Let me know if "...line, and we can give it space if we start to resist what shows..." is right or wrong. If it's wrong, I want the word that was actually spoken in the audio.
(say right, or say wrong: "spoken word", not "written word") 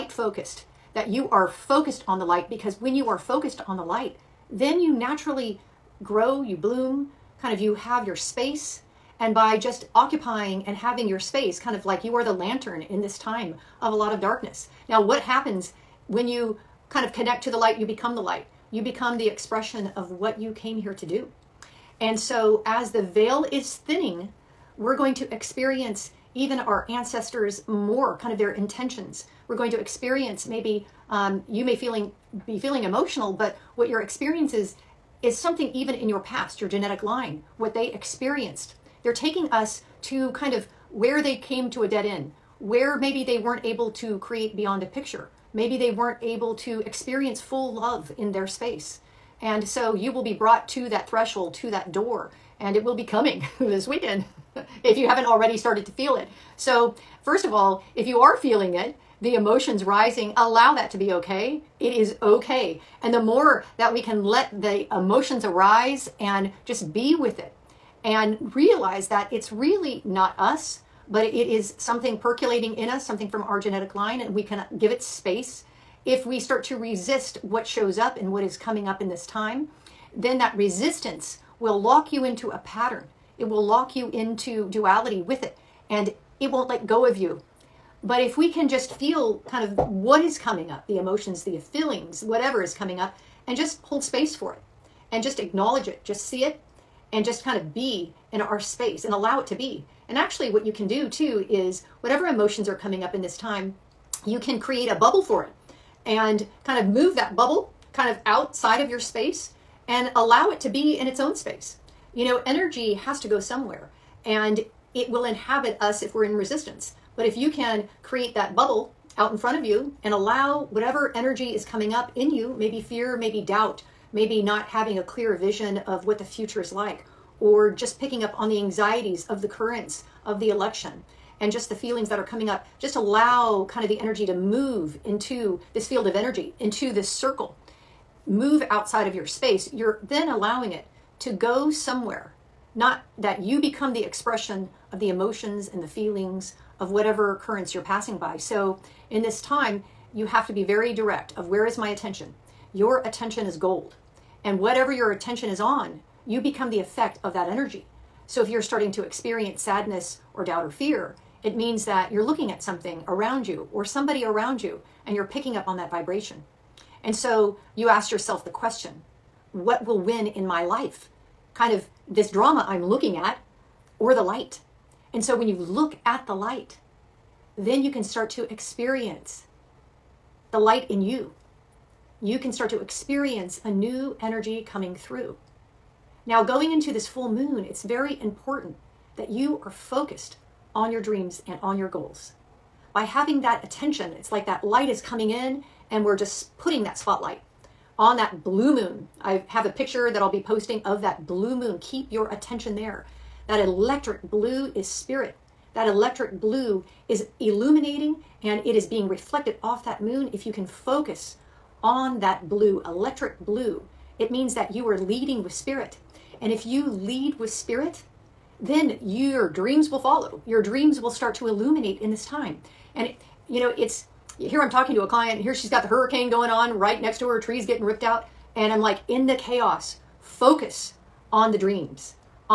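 right.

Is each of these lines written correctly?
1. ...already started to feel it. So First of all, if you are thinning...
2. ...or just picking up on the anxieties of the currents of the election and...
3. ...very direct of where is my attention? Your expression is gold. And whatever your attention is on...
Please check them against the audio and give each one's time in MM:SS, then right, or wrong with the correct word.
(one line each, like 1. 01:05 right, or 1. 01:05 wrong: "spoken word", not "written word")
1. 00:55 wrong: "feeling", not "thinning"
2. 02:07 right
3. 02:30 wrong: "attention", not "expression".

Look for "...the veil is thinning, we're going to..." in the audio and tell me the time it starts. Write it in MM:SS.
00:22.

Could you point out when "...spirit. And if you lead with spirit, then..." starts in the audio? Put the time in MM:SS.
03:35.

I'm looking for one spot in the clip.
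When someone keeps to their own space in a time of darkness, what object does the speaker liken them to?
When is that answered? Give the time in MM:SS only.
00:12.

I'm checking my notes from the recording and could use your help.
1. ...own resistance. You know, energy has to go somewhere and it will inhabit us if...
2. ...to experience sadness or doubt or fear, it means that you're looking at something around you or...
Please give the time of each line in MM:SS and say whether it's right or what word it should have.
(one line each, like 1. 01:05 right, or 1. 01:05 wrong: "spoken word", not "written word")
1. 01:51 wrong: "space", not "resistance"
2. 02:38 right.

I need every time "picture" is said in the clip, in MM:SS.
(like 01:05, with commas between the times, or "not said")
00:44, 03:19.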